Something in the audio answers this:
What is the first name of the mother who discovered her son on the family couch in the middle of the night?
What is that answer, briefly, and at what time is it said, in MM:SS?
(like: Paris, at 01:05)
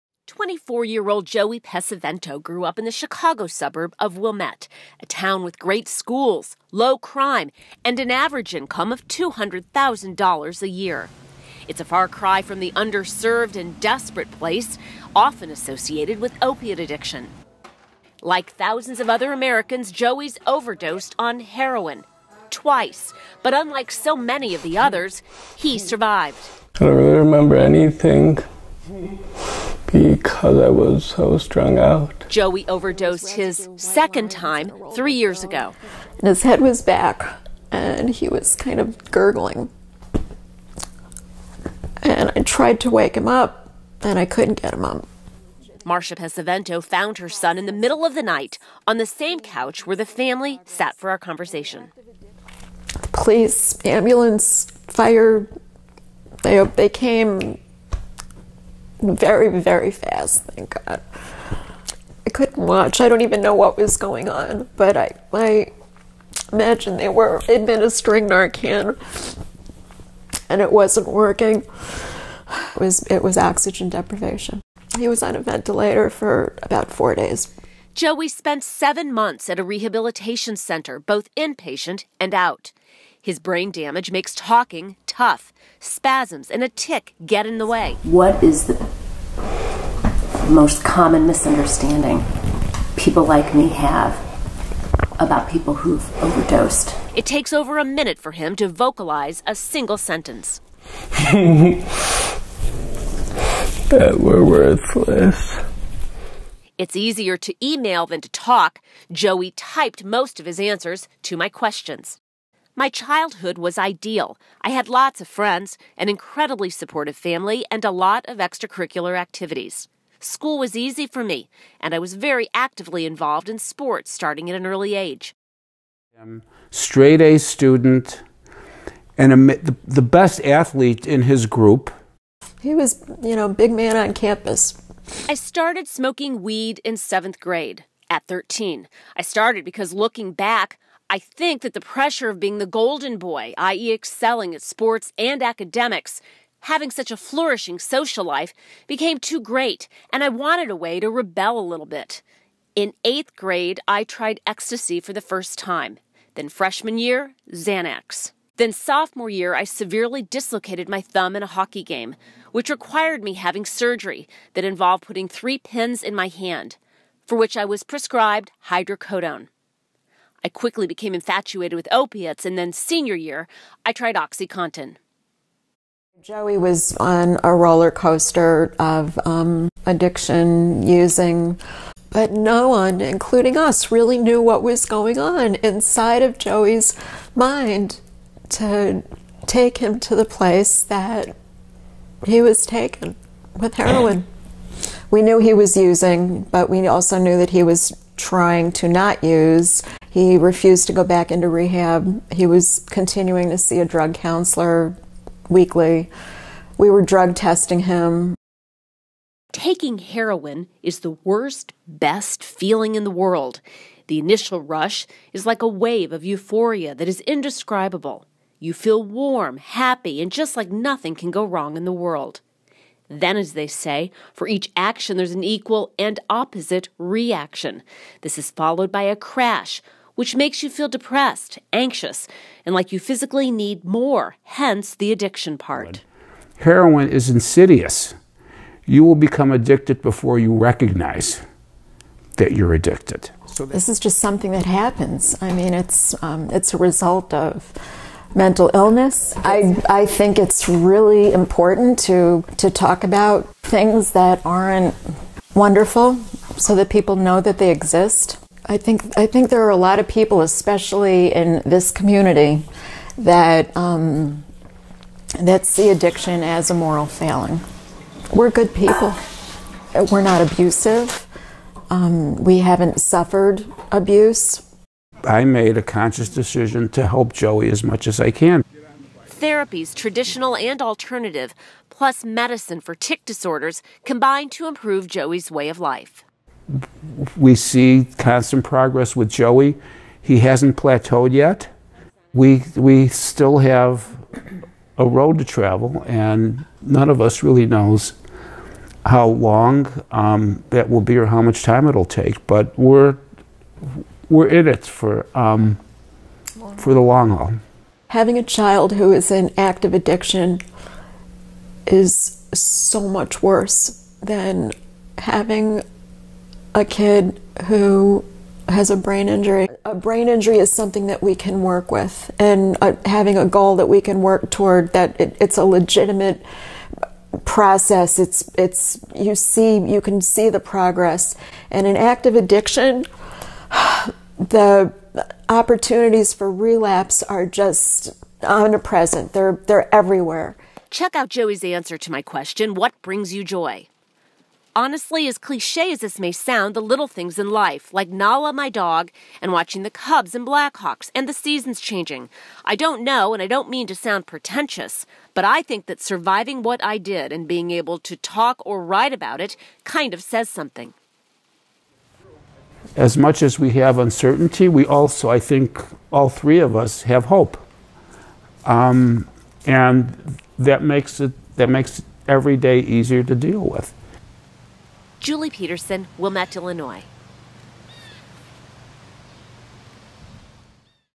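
Marcia, at 00:45.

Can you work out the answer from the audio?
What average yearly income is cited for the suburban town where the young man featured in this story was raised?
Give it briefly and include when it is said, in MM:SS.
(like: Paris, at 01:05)
$200,000, at 00:09.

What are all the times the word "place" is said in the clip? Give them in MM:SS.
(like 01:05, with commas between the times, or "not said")
00:14, 03:10.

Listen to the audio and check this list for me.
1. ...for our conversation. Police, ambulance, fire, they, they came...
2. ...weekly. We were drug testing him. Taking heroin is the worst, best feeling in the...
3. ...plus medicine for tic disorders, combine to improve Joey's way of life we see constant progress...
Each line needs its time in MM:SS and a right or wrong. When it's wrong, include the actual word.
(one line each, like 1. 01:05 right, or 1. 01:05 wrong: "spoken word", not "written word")
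1. 00:50 right
2. 03:25 right
3. 04:41 right.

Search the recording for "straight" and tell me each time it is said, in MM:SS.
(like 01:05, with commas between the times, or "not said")
02:06.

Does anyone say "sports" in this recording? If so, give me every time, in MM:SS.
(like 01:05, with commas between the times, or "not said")
02:03, 02:24.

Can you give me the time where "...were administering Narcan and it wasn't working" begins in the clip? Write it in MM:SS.
01:07.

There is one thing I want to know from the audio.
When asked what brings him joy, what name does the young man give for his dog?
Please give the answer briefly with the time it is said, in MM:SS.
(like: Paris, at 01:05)
Nala, at 05:48.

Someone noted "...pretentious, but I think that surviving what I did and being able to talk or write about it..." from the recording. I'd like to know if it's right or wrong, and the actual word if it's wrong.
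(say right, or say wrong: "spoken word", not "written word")
right.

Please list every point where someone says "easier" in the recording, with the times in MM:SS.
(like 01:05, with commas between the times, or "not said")
01:46, 06:12.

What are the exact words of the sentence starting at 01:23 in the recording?
His brain damage makes talking tough.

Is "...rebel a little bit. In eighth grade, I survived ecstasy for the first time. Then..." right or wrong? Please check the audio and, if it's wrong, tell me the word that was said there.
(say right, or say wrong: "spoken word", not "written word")
wrong: "tried", not "survived".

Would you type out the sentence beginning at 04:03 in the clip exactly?
So this is just something that happens.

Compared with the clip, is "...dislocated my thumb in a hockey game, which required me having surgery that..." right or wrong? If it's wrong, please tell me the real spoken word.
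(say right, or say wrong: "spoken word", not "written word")
right.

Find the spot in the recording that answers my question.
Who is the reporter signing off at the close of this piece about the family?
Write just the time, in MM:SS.
06:15.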